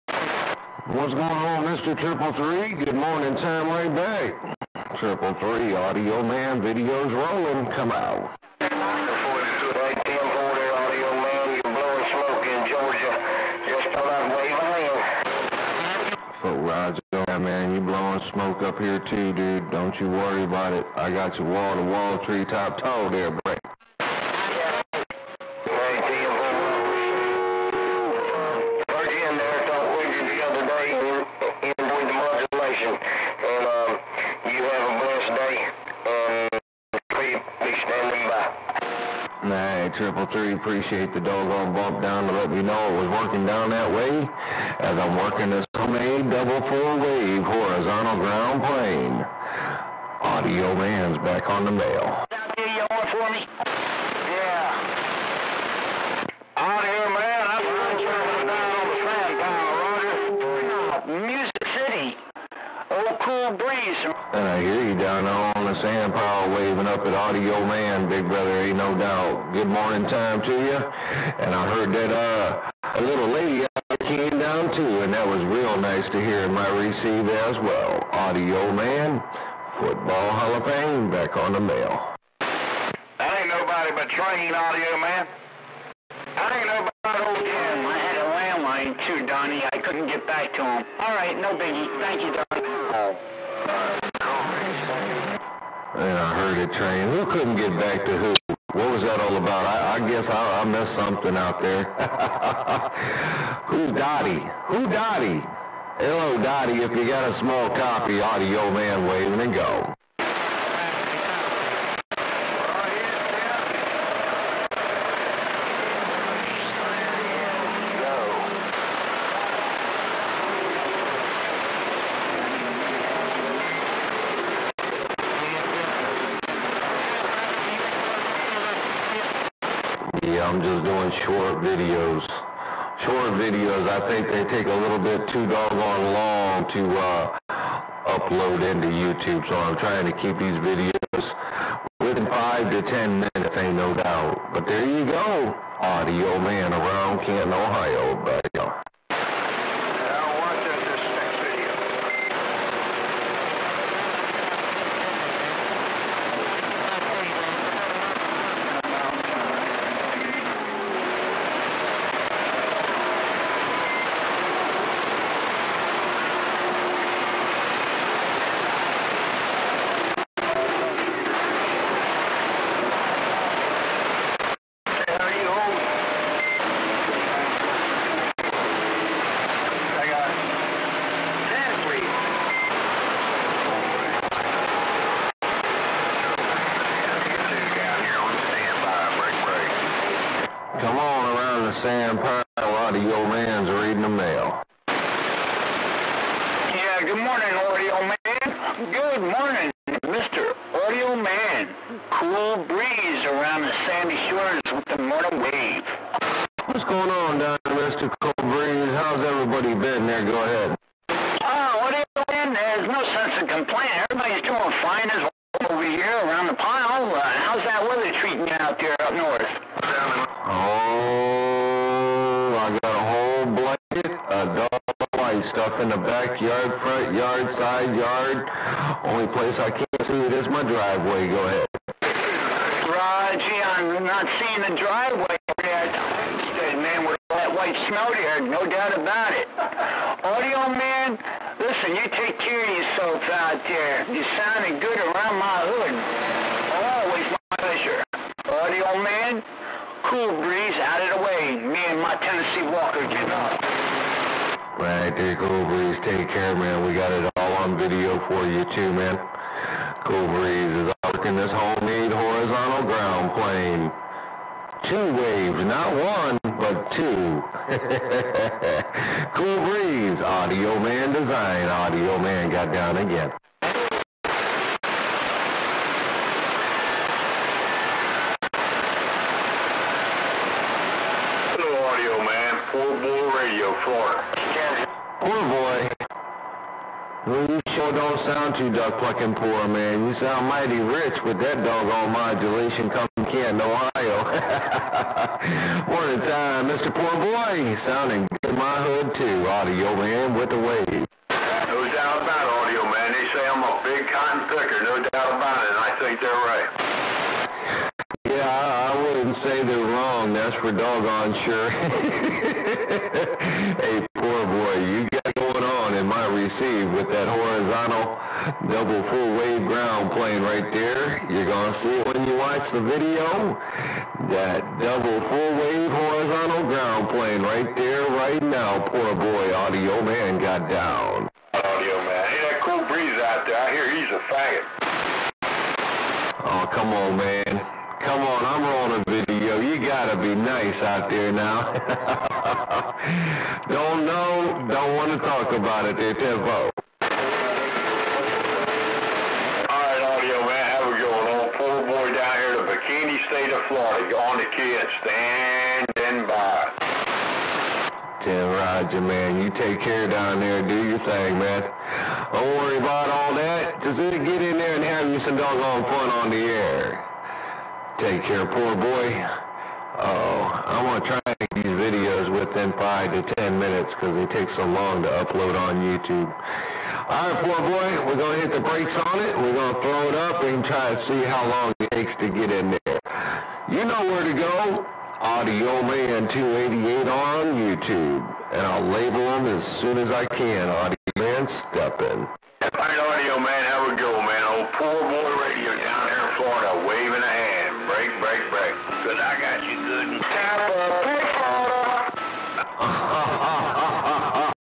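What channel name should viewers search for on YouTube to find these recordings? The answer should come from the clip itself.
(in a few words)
Audio Man 288.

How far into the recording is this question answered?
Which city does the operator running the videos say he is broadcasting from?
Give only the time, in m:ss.
2:27.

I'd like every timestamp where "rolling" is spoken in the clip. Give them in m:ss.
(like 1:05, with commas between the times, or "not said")
0:07, 5:38.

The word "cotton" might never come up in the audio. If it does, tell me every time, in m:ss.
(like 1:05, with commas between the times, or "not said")
5:04.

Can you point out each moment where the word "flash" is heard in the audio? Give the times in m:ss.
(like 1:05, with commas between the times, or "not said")
not said.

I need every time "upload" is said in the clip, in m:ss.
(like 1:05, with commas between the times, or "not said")
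2:18, 6:15.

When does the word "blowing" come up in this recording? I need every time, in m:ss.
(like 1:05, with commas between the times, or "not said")
0:17.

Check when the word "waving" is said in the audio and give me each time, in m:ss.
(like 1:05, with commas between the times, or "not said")
1:06, 1:49.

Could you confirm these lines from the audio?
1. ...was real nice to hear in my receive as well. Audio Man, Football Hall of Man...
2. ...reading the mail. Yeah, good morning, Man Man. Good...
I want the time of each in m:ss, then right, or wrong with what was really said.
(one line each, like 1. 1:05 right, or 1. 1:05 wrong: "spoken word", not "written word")
1. 1:15 wrong: "Fame", not "Man"
2. 3:13 wrong: "Audio", not "Man".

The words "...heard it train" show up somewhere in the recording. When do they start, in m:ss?
1:36.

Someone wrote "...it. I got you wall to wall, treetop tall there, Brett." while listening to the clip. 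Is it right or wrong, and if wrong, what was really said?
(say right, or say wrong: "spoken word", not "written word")
right.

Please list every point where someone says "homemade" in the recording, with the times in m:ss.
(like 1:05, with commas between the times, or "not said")
0:45, 4:21.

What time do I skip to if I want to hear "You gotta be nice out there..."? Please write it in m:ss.
5:39.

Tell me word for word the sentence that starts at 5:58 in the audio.
Tim Roger, man, you take care down there, do your thing, man.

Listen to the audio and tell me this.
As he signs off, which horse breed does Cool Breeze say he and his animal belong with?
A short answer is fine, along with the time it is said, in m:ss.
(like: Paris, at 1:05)
Tennessee Walker, at 4:12.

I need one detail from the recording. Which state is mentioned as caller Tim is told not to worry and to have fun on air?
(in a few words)
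Florida.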